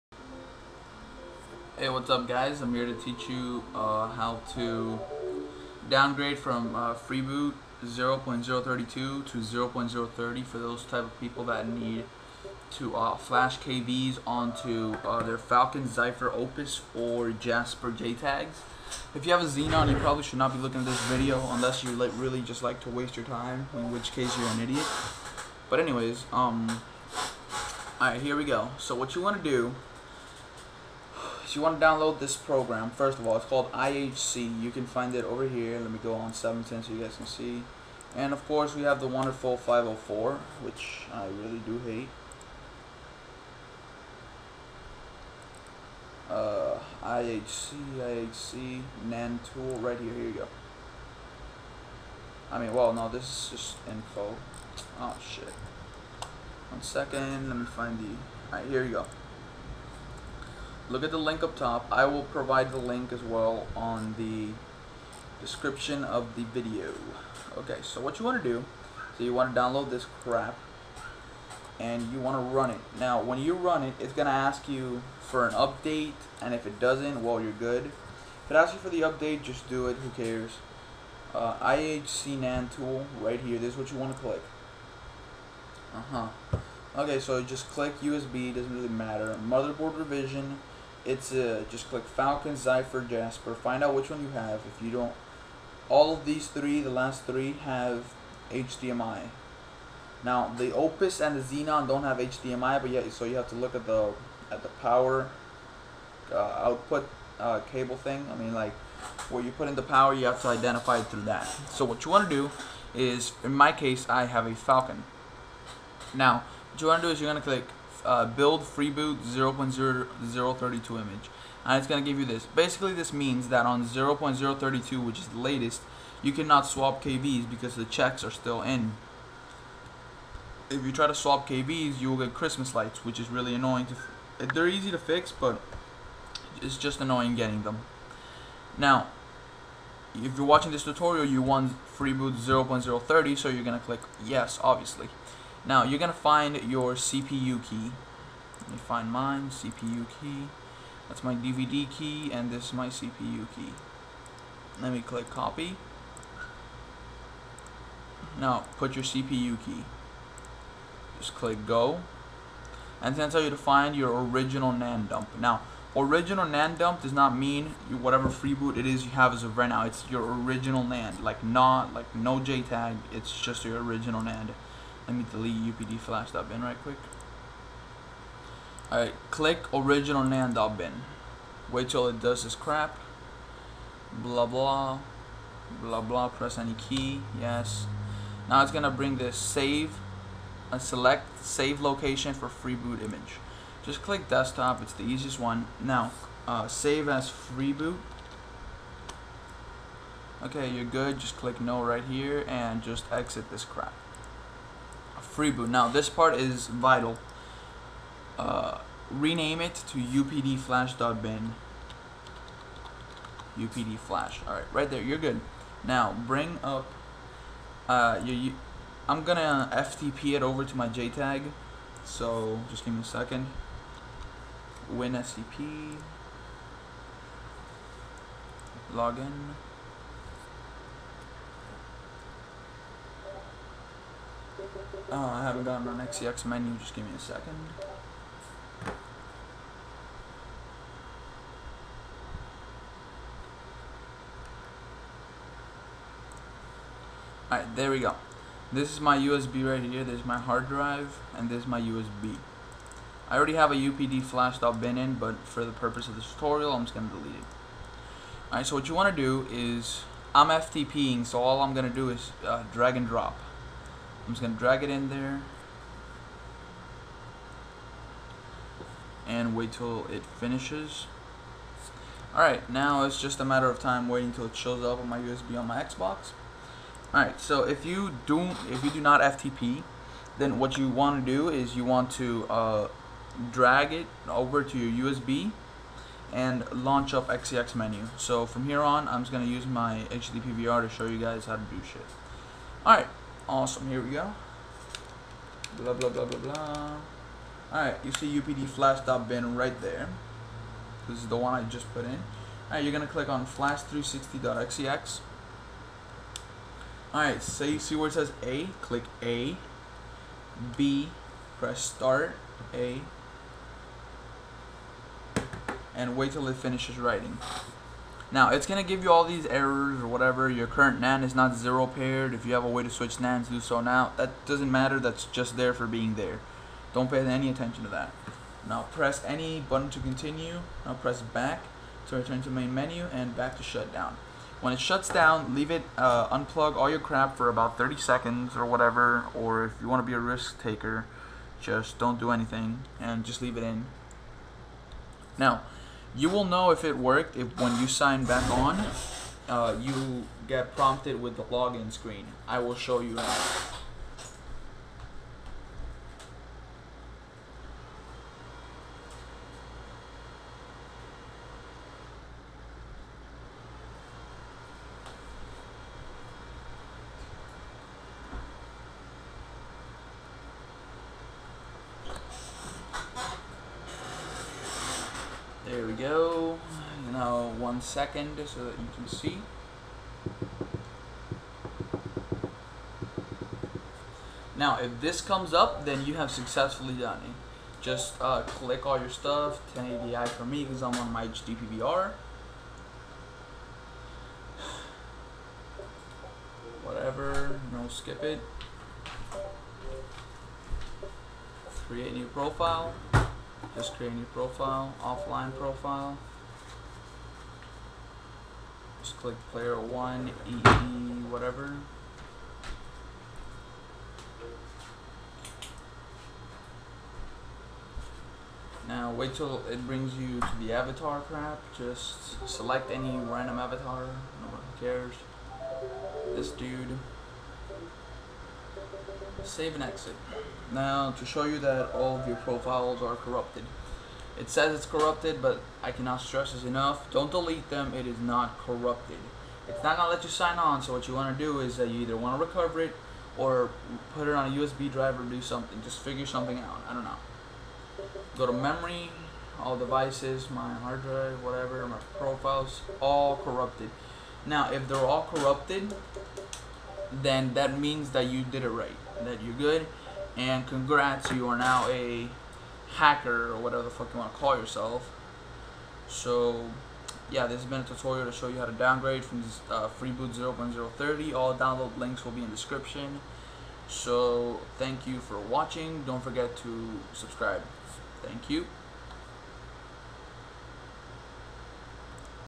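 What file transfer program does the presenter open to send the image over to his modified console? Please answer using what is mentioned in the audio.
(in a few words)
WinSCP.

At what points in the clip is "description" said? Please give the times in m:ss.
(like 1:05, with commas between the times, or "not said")
1:05, 7:52.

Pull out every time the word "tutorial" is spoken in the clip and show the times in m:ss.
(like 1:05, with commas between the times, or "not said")
2:20, 4:16, 7:47.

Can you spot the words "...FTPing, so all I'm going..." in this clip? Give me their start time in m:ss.
4:20.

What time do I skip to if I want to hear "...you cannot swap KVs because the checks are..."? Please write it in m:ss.
2:06.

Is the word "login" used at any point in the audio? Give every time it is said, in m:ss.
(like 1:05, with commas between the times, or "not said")
3:48, 5:51.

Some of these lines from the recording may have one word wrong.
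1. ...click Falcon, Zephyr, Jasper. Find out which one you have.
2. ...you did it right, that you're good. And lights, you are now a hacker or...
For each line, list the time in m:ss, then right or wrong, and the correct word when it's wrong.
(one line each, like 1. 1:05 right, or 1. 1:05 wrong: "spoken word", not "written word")
1. 1:31 right
2. 7:38 wrong: "congrats", not "lights".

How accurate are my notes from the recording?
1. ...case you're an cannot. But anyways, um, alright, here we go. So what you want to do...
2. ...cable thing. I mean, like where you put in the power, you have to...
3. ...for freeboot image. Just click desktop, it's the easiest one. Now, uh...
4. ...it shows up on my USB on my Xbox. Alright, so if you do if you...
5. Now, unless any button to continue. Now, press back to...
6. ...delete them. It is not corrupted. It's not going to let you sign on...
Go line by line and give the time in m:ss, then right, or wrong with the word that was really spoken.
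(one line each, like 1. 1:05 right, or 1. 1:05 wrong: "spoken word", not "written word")
1. 0:24 wrong: "idiot", not "cannot"
2. 1:47 right
3. 3:12 right
4. 4:34 right
5. 5:28 wrong: "press", not "unless"
6. 7:17 right.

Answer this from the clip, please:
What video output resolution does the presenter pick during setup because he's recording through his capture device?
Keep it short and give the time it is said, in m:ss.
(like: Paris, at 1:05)
1080i, at 6:29.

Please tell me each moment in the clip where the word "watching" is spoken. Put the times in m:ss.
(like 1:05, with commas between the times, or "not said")
2:20, 7:55.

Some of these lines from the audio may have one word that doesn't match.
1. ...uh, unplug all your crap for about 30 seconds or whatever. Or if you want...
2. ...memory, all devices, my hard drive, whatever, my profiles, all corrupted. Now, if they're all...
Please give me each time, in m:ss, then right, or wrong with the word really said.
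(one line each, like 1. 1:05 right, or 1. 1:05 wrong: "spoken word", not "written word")
1. 5:35 right
2. 7:28 right.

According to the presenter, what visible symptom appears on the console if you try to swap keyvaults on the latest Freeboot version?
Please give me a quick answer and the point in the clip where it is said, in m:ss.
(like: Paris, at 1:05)
Christmas lights, at 2:12.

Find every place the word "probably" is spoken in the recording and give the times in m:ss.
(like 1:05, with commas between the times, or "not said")
0:19.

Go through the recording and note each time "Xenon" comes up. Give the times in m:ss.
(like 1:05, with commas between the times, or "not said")
0:19, 1:41.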